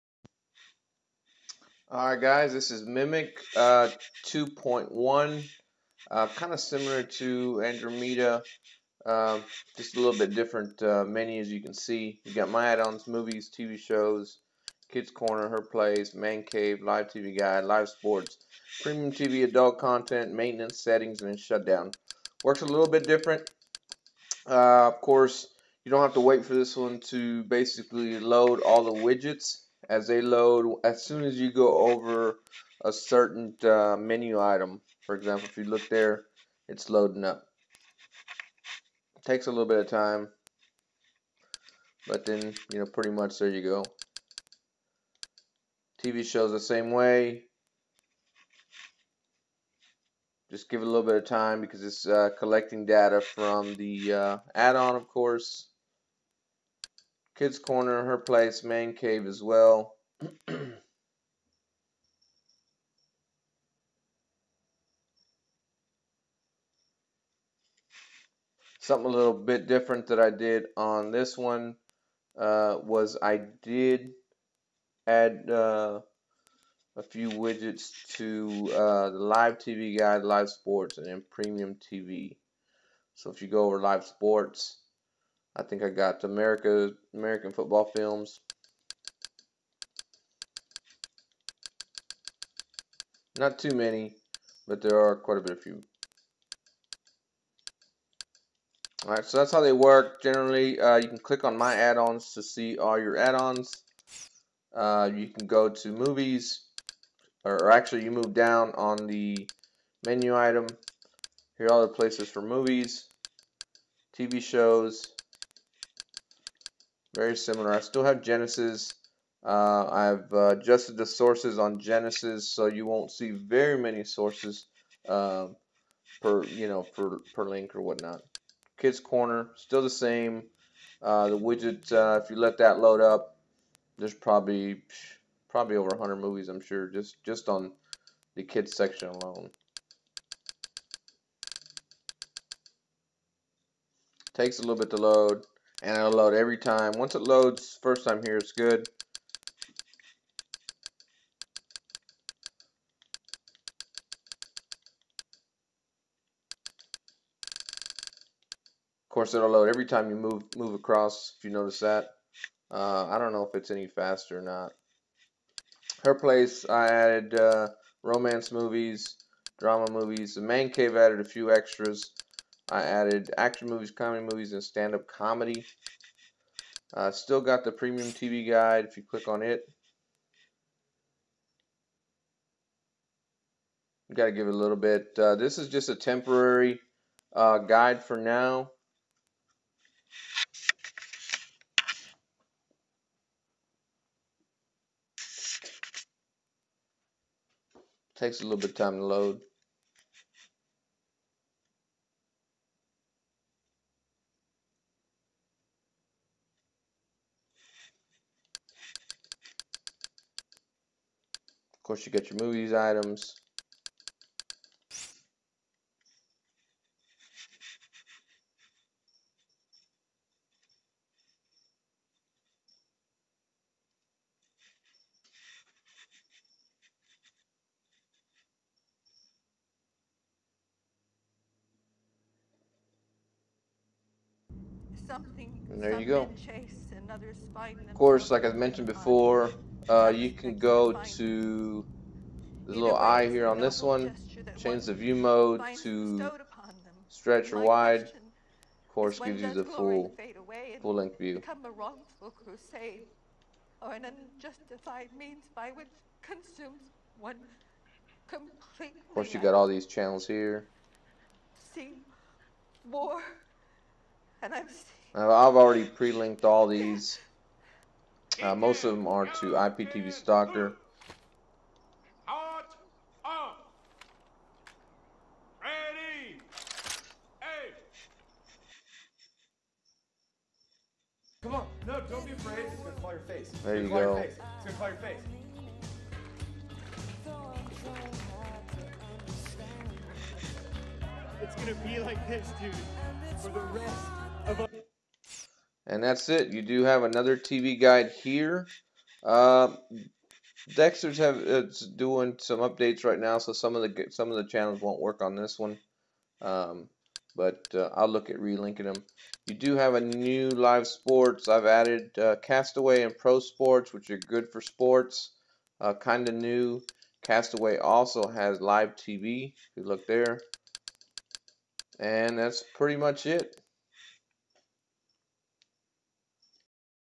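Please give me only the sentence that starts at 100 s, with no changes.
Generally, uh, you can click on My Add-ons to see all your add-ons.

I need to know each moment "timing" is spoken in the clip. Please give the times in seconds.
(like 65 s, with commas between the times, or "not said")
not said.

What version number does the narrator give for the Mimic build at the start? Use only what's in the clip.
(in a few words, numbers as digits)
2.1.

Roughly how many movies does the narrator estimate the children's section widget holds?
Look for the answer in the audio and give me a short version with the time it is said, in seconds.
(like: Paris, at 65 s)
over 100, at 135 s.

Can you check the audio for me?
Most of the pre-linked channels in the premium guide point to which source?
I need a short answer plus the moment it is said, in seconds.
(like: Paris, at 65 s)
IPTV Stalker, at 269 s.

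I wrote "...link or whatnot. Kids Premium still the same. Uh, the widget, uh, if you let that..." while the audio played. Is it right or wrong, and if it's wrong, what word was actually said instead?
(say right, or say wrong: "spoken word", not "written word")
wrong: "Corner", not "Premium".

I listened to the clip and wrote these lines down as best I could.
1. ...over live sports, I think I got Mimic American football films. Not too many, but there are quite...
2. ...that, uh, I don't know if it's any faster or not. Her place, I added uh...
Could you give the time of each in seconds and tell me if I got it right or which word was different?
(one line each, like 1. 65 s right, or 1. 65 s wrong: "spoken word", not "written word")
1. 83 s wrong: "America", not "Mimic"
2. 161 s right.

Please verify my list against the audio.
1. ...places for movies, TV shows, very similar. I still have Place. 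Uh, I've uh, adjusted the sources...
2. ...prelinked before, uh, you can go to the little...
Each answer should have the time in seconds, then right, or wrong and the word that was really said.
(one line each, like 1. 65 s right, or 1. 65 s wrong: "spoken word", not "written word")
1. 111 s wrong: "Genesis", not "Place"
2. 238 s wrong: "mentioned", not "prelinked".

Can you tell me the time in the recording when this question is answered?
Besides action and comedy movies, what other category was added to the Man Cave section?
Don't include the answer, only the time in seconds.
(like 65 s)
174 s.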